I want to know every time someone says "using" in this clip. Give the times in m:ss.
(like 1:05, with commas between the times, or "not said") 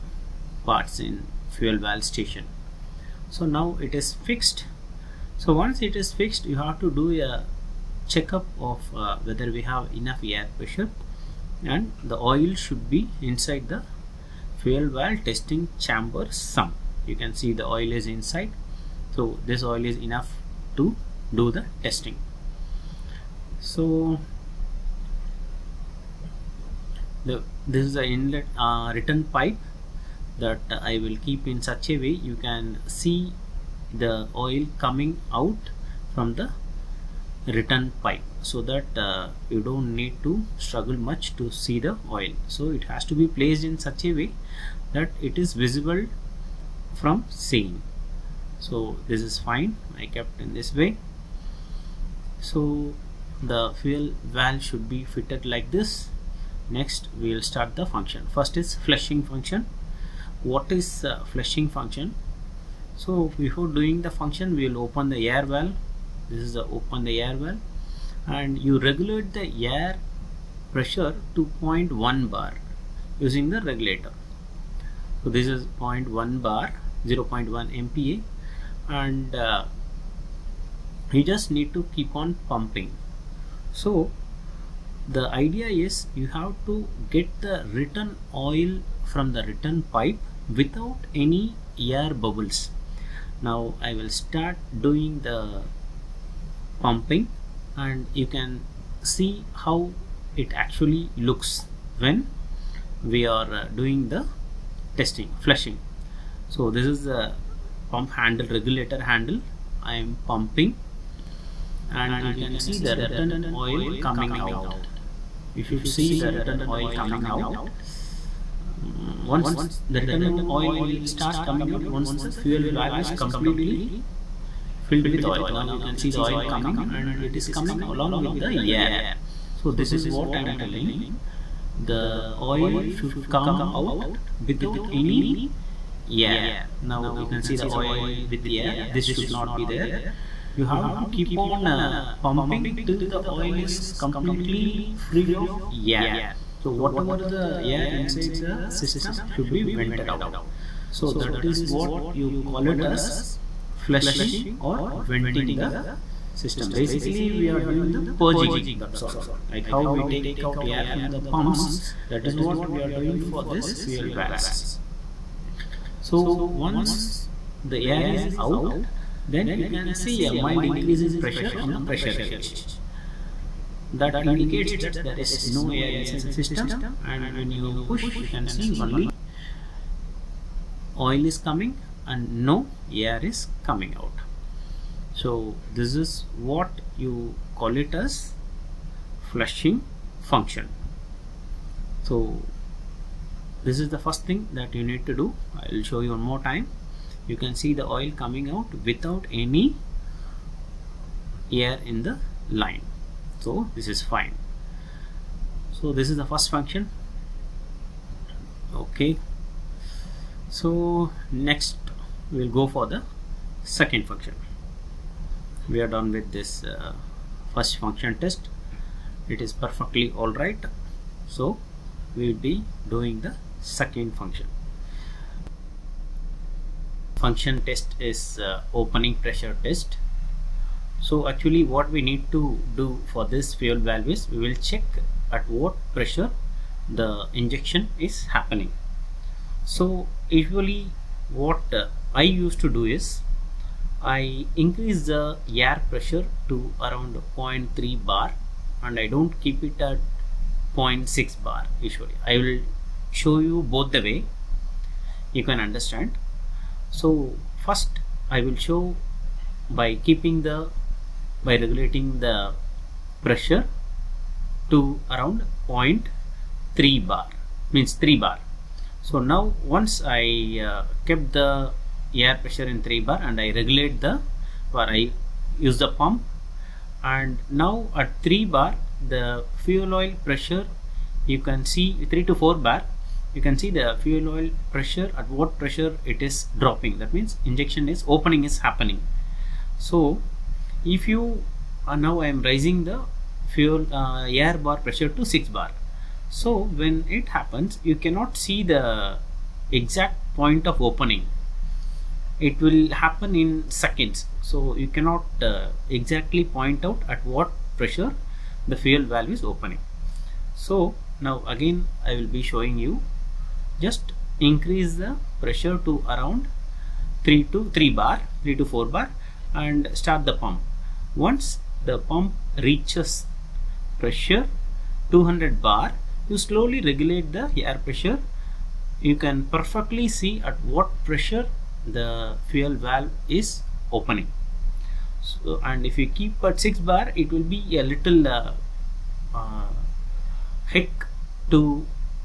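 1:13.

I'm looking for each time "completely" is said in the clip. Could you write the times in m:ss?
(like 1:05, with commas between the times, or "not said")
2:03, 2:23.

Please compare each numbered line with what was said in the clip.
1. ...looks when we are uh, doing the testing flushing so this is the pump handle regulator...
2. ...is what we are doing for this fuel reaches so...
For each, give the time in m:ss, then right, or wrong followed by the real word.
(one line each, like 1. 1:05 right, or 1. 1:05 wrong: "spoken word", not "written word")
1. 1:41 right
2. 2:42 wrong: "valves", not "reaches".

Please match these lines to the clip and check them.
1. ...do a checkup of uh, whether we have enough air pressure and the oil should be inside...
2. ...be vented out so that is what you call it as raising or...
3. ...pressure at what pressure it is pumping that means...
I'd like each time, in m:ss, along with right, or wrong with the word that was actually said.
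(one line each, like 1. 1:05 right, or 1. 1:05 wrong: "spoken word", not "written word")
1. 0:06 right
2. 2:29 wrong: "flushing", not "raising"
3. 4:44 wrong: "dropping", not "pumping".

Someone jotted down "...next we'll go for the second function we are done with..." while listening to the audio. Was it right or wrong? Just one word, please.
right.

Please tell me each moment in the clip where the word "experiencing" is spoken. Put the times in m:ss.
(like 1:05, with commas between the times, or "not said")
not said.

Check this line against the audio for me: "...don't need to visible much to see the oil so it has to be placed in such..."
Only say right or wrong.
wrong.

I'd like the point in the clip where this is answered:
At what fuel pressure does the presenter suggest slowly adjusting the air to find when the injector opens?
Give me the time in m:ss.
5:25.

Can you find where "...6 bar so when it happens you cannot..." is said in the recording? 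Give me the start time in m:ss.
4:55.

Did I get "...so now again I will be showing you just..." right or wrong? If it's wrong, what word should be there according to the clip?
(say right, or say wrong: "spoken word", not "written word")
right.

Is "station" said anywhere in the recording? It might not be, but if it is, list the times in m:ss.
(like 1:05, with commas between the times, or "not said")
0:02.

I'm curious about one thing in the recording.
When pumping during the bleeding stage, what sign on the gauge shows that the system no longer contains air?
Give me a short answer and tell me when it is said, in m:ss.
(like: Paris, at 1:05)
Mild increase in pressure, at 2:50.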